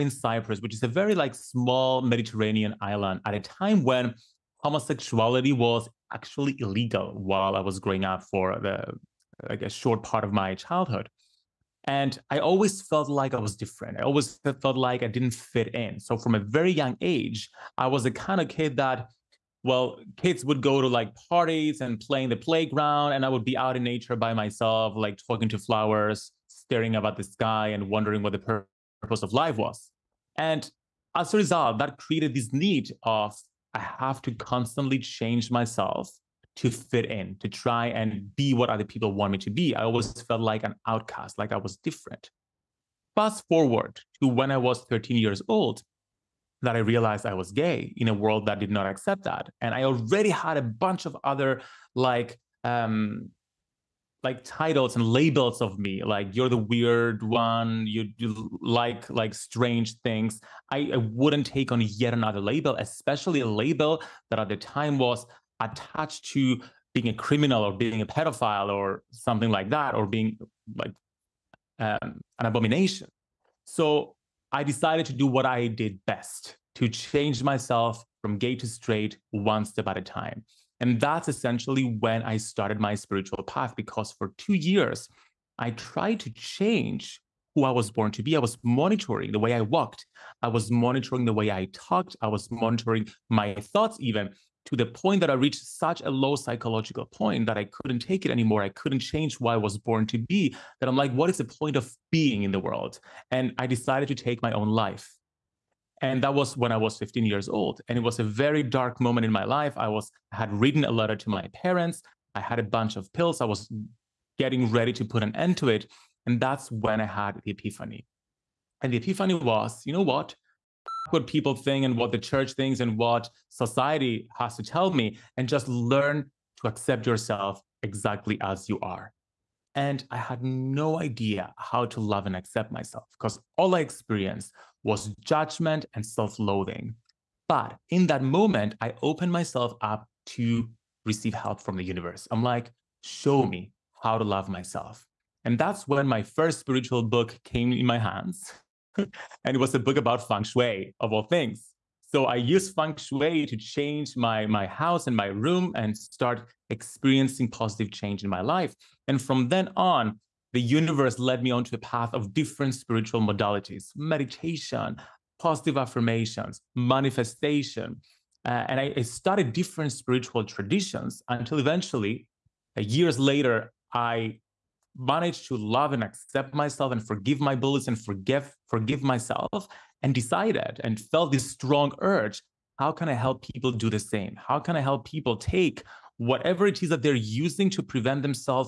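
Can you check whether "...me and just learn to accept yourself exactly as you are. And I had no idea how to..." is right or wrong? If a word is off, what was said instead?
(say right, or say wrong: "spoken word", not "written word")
right.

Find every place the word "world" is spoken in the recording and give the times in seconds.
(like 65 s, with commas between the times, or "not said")
48 s, 102 s.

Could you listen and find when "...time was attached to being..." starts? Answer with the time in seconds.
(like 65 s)
64 s.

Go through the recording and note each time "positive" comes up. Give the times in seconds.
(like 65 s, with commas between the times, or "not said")
157 s, 165 s.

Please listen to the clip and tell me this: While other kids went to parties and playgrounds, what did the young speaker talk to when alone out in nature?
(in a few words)
flowers.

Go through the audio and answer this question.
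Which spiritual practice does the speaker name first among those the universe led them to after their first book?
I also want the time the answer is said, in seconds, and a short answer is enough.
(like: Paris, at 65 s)
meditation, at 163 s.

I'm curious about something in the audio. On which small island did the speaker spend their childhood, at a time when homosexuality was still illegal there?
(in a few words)
Cyprus.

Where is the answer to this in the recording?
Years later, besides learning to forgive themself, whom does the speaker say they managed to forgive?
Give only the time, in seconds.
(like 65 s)
177 s.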